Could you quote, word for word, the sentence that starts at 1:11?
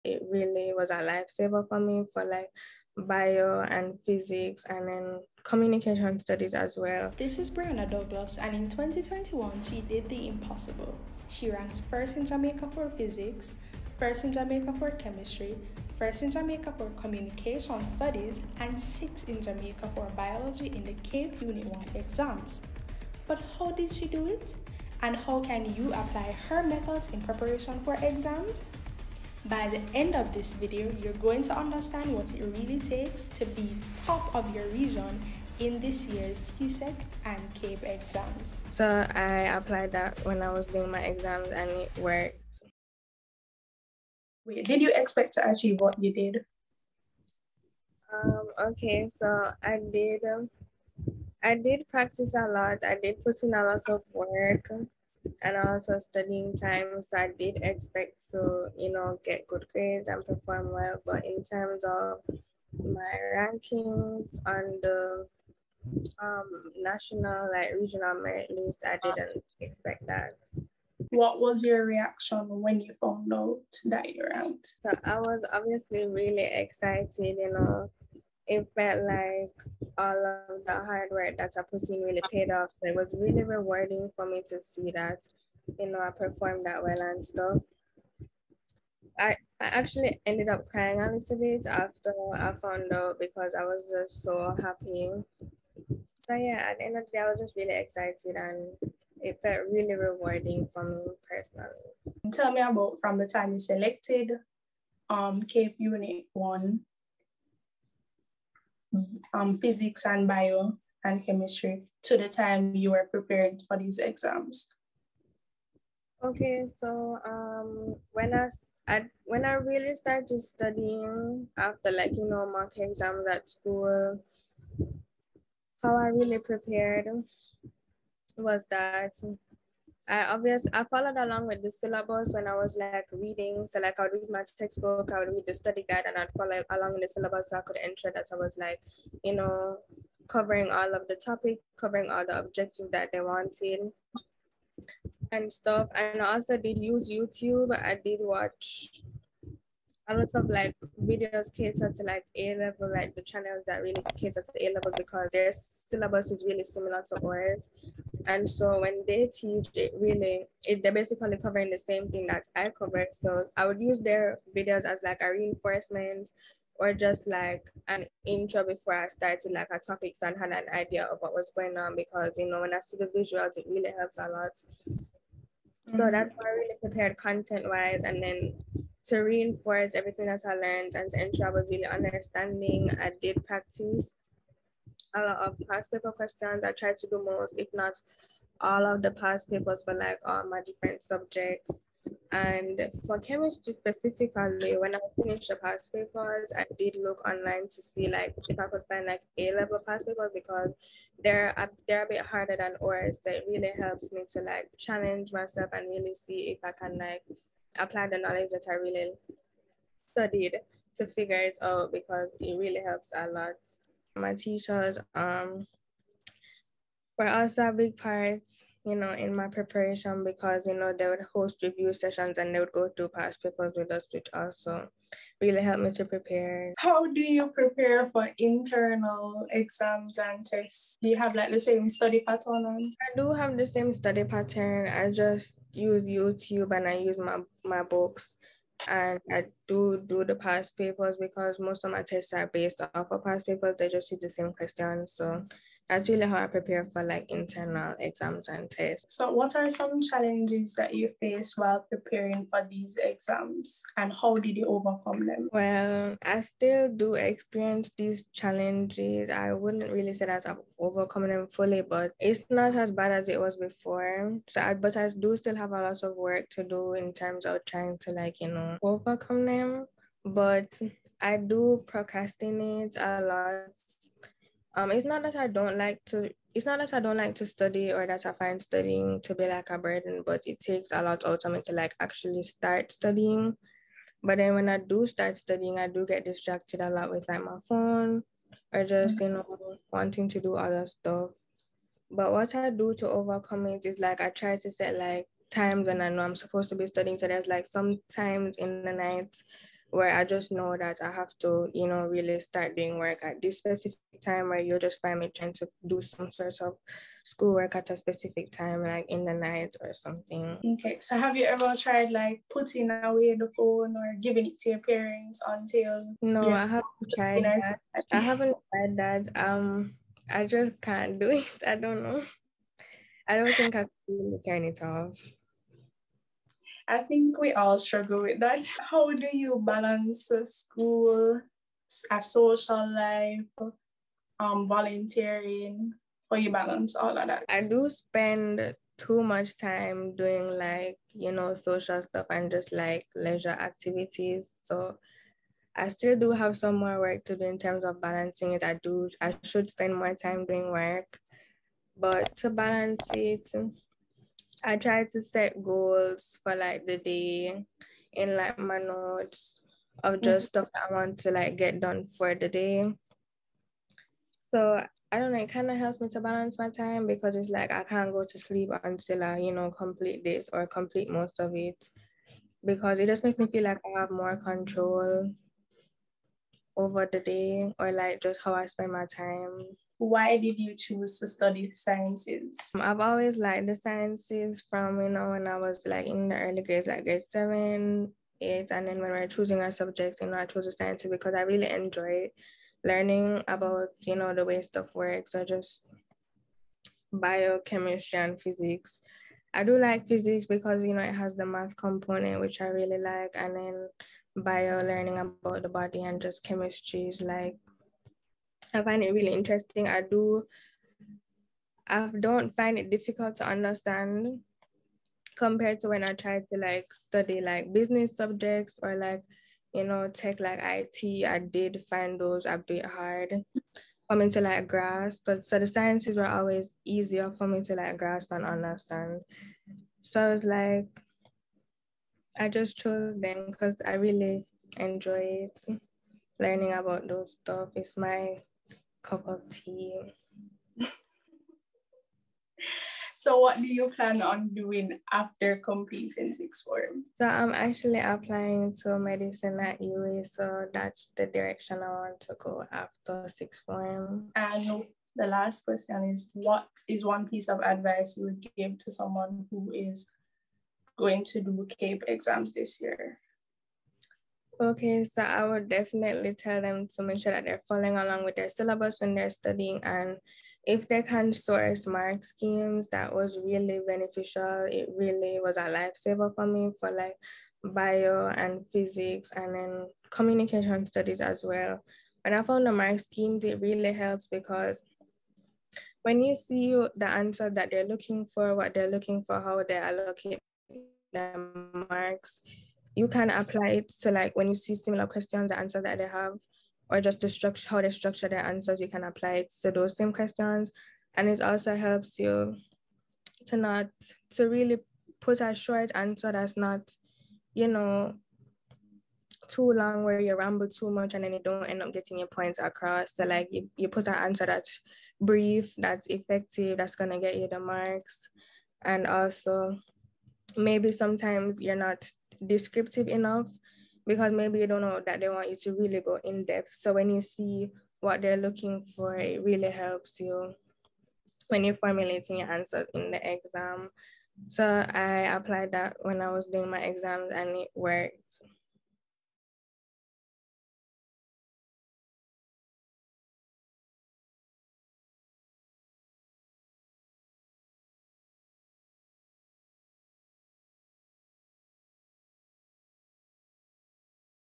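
What was your reaction when you found out that you out?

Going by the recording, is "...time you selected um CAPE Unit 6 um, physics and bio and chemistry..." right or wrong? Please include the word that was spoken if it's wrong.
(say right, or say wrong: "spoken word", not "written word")
wrong: "1", not "6".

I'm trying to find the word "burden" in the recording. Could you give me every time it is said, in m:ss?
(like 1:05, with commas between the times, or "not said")
4:39.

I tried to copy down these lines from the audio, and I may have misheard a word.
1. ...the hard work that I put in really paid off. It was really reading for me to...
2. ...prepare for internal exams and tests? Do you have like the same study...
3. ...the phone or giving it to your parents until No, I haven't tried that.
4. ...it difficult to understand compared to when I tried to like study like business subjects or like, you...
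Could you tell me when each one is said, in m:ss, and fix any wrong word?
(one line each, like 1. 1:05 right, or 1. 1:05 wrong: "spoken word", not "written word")
1. 1:20 wrong: "rewarding", not "reading"
2. 3:47 right
3. 5:13 right
4. 6:52 right.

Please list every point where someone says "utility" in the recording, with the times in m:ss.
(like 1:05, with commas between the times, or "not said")
not said.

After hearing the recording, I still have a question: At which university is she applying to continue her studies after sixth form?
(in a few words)
UWI.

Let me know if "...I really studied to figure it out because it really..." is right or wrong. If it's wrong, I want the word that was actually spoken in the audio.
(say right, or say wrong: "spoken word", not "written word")
right.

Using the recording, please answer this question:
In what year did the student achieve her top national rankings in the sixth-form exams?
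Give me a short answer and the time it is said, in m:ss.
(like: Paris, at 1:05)
2021, at 0:08.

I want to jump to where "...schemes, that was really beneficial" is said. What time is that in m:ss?
7:52.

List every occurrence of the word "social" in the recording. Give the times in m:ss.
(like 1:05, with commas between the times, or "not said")
5:32, 5:41.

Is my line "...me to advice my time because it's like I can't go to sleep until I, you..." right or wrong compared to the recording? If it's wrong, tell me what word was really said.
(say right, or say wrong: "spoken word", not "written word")
wrong: "balance", not "advice".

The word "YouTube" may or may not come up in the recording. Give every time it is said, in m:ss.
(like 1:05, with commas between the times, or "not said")
2:27, 3:56.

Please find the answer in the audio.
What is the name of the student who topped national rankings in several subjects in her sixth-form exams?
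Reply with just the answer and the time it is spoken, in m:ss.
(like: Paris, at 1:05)
Brianna Douglas, at 0:07.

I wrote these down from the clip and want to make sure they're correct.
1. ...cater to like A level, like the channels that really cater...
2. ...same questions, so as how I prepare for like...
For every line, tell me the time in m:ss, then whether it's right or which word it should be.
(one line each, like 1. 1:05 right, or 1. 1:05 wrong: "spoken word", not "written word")
1. 2:31 right
2. 4:04 right.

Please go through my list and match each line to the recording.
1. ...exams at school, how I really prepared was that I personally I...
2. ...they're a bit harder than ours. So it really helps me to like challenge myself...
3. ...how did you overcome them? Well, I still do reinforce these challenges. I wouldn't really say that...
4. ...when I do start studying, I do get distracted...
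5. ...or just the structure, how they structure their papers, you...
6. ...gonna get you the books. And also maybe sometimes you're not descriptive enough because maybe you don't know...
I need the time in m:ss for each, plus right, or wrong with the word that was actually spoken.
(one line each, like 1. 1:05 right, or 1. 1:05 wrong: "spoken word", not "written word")
1. 2:02 wrong: "obviously", not "personally"
2. 3:21 right
3. 4:14 wrong: "experience", not "reinforce"
4. 4:44 right
5. 8:16 wrong: "answers", not "papers"
6. 8:36 wrong: "marks", not "books".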